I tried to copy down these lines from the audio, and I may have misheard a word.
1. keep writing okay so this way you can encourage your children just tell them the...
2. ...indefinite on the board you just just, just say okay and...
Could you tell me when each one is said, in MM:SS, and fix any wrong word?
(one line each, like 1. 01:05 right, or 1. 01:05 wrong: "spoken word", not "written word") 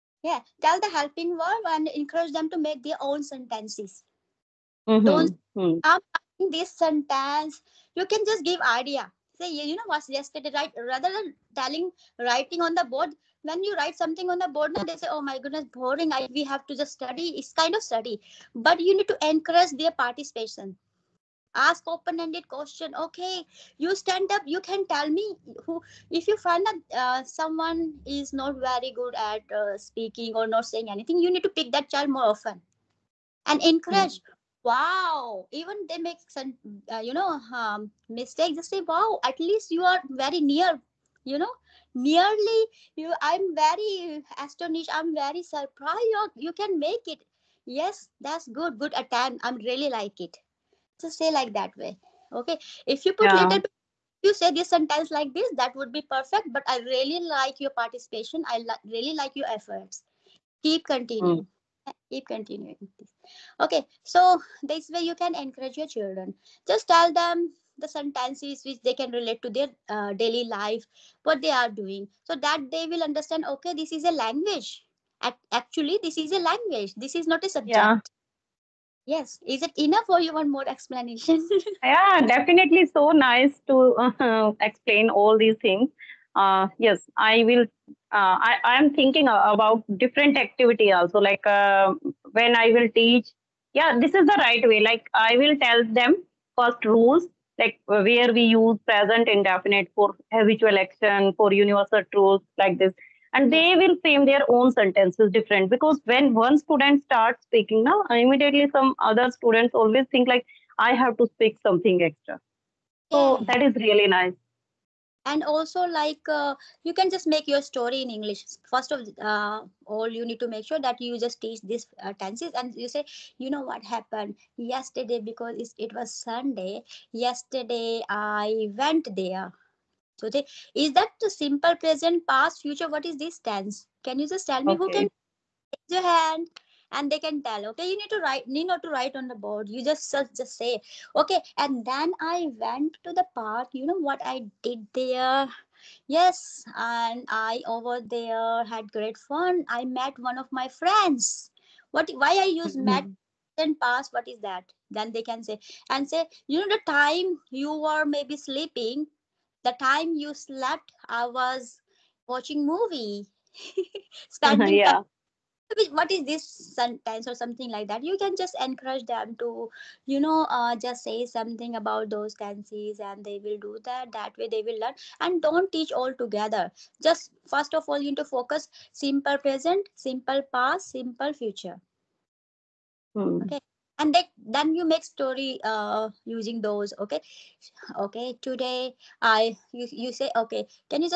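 1. 01:02 wrong: "continuing", not "writing"
2. 02:18 wrong: "write", not "indefinite".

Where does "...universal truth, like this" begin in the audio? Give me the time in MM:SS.
01:41.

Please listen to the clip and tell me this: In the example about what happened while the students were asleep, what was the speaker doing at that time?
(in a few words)
watching movie.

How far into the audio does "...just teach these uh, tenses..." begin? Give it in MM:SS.
02:01.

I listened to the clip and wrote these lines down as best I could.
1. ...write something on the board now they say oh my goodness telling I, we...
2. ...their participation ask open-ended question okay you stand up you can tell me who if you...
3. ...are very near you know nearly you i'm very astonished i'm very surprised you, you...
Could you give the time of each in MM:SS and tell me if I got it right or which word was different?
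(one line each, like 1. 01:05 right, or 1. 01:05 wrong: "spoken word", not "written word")
1. 00:13 wrong: "boring", not "telling"
2. 00:19 right
3. 00:39 right.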